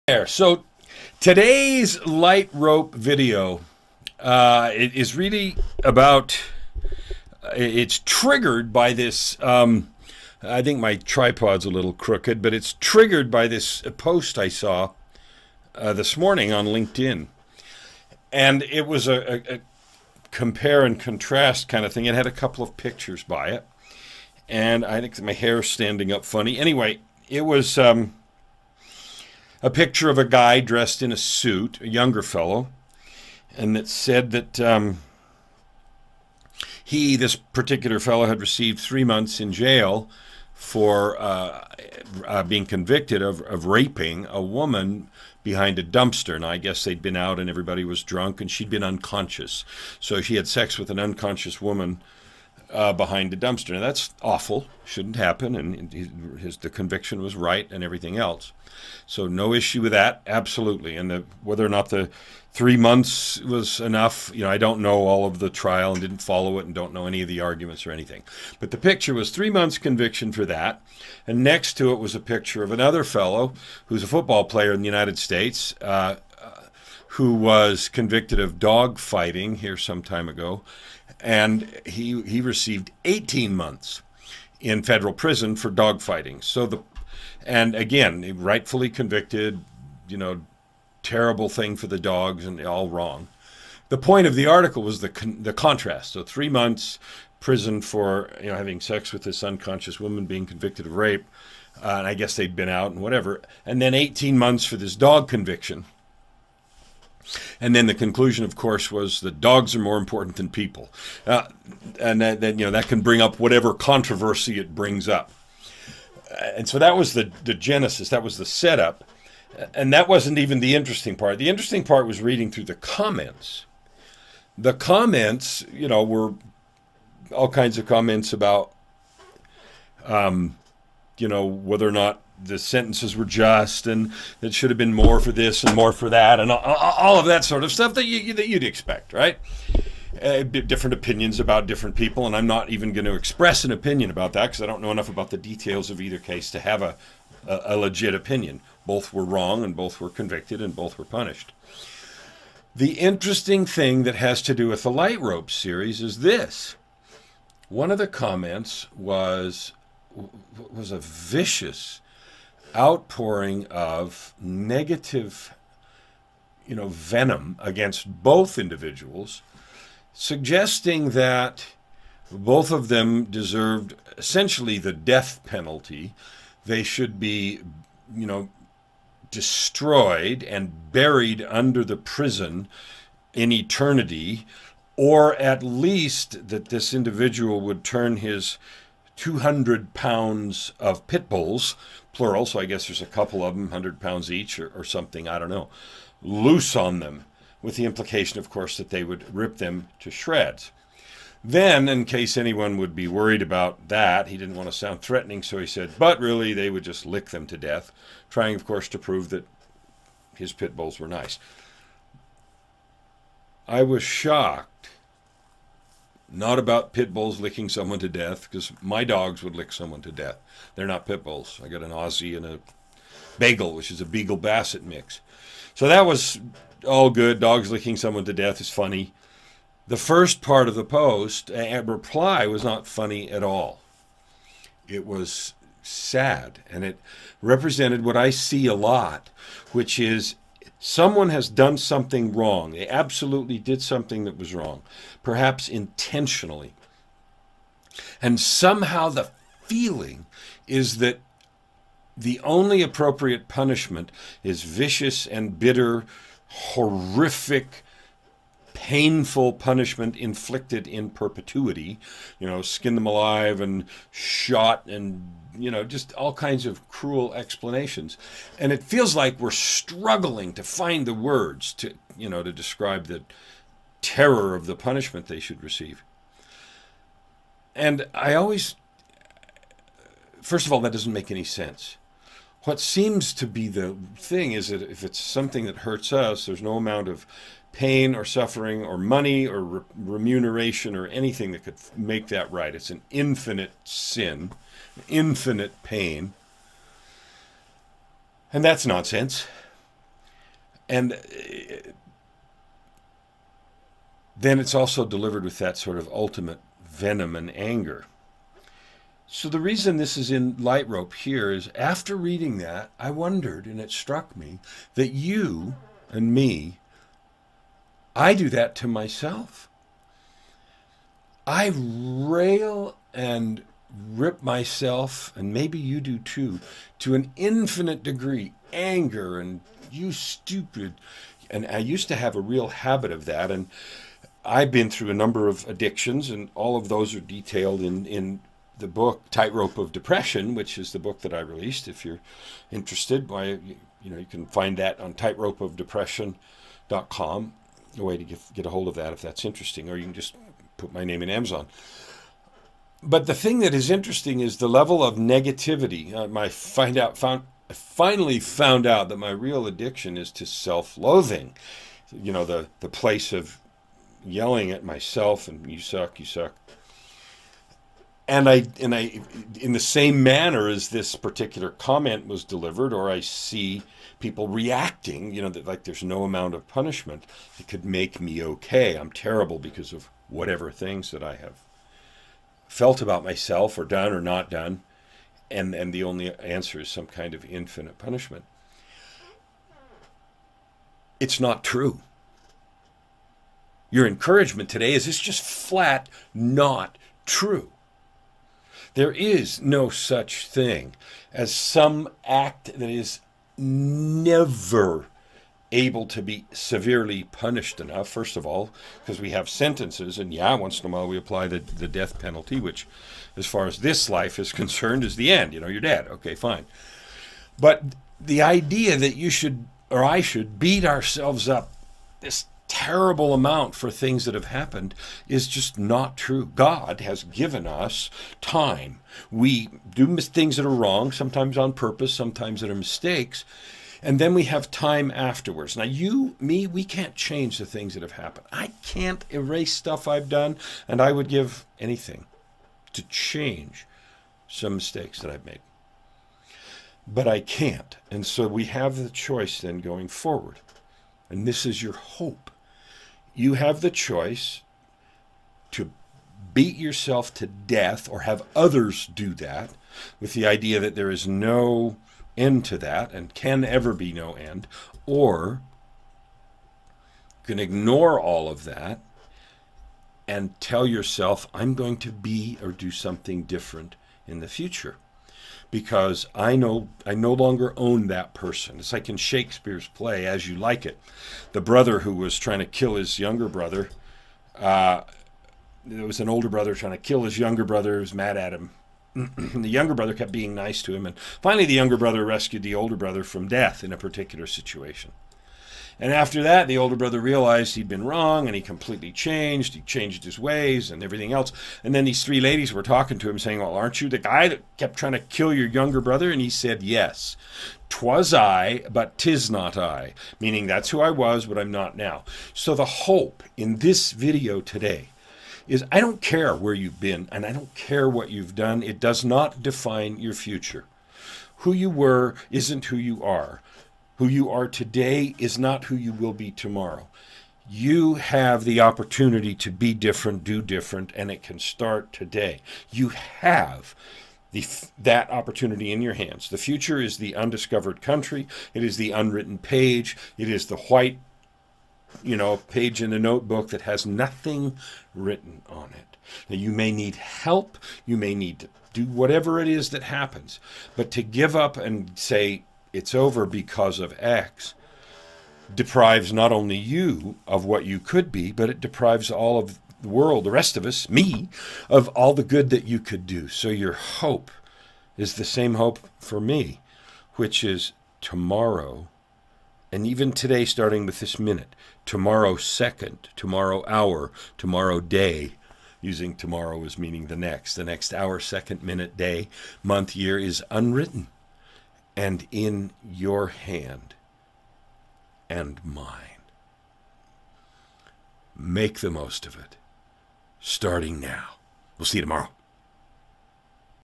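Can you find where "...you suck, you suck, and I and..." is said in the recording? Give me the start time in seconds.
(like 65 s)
365 s.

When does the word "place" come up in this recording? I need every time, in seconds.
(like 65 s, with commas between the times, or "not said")
362 s.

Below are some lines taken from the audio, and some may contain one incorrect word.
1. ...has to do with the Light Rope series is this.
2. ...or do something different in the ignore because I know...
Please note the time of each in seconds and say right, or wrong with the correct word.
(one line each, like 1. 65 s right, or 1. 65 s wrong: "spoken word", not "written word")
1. 154 s right
2. 472 s wrong: "future", not "ignore".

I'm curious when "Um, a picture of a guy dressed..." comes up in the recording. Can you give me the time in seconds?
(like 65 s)
27 s.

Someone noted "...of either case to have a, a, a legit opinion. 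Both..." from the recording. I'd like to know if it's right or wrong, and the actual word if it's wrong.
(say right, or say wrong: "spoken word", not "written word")
right.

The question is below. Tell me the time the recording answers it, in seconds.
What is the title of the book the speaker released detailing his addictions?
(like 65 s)
339 s.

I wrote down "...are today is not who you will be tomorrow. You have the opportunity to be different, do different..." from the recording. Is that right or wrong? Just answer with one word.
right.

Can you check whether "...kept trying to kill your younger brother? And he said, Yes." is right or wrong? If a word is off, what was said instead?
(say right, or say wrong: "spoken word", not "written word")
right.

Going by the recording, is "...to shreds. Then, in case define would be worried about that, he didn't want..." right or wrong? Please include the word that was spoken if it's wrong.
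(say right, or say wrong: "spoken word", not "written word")
wrong: "anyone", not "define".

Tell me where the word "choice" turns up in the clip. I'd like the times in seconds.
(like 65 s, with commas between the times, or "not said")
449 s, 453 s.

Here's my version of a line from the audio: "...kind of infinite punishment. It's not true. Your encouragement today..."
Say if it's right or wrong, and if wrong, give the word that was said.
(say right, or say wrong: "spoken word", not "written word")
right.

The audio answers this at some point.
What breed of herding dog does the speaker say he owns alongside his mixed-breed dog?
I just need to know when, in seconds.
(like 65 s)
221 s.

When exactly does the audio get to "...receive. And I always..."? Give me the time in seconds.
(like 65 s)
275 s.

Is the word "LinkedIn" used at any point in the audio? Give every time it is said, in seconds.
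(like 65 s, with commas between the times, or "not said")
16 s.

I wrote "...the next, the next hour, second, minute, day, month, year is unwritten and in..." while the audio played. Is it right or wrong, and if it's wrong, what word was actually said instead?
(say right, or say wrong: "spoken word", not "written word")
right.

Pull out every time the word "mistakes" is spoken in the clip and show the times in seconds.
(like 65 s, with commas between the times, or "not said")
432 s, 444 s.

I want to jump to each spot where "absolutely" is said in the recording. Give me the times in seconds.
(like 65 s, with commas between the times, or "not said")
60 s, 242 s.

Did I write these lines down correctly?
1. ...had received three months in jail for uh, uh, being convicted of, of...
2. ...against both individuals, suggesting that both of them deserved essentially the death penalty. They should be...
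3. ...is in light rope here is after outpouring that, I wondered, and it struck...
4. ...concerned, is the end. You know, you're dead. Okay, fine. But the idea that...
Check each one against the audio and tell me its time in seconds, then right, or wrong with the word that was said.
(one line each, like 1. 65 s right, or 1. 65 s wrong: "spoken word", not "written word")
1. 38 s right
2. 167 s right
3. 310 s wrong: "reading", not "outpouring"
4. 414 s right.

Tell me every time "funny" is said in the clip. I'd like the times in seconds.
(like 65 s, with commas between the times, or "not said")
26 s, 228 s, 232 s.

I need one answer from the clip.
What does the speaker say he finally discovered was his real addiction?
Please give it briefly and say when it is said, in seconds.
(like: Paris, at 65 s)
self-loathing, at 360 s.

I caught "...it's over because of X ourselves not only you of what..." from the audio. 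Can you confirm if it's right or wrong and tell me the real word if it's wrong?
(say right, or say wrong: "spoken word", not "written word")
wrong: "deprives", not "ourselves".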